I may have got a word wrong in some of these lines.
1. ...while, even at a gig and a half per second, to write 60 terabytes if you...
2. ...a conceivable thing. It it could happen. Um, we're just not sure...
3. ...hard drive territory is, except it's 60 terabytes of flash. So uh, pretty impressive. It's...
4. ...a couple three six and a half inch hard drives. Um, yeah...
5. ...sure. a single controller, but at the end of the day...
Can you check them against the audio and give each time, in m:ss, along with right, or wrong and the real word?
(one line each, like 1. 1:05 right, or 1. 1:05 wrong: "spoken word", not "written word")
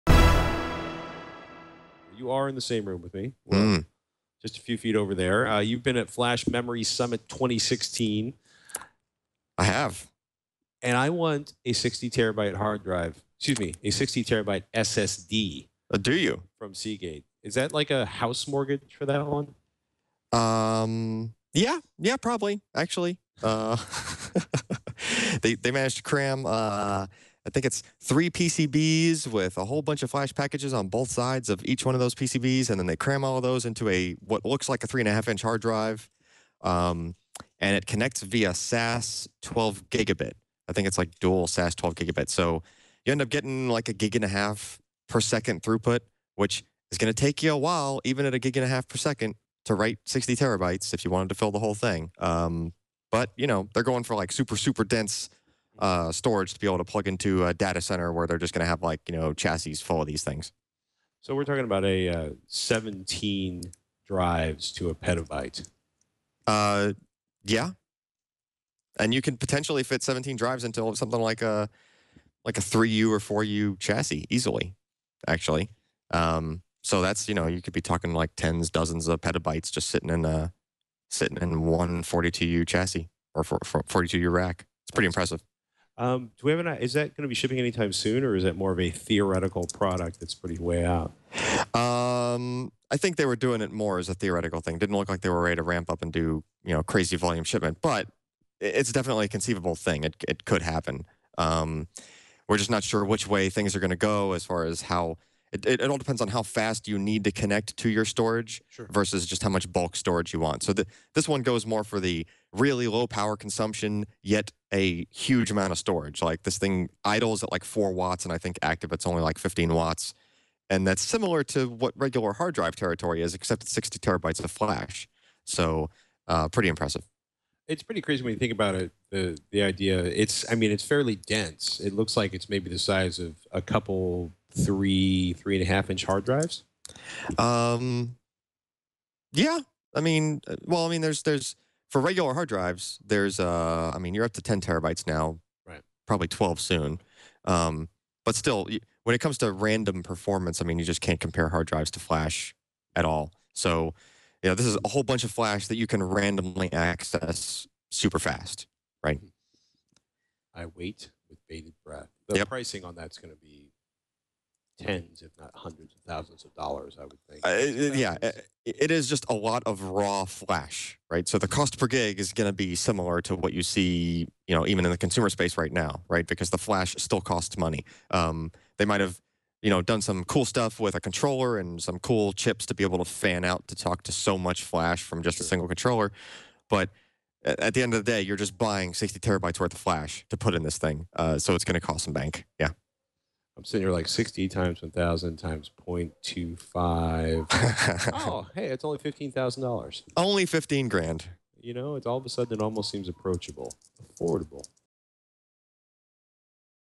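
1. 0:47 right
2. 1:39 right
3. 2:02 right
4. 2:13 wrong: "three", not "six"
5. 3:05 right.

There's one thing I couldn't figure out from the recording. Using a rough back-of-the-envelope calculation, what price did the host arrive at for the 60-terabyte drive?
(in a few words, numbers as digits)
$15,000.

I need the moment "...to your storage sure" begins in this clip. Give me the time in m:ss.
1:47.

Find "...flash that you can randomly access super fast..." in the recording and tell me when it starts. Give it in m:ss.
2:35.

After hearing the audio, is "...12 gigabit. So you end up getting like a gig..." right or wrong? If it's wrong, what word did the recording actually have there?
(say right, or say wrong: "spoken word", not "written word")
right.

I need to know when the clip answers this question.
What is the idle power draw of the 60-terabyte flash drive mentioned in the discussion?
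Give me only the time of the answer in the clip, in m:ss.
1:57.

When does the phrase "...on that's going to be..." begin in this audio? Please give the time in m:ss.
2:42.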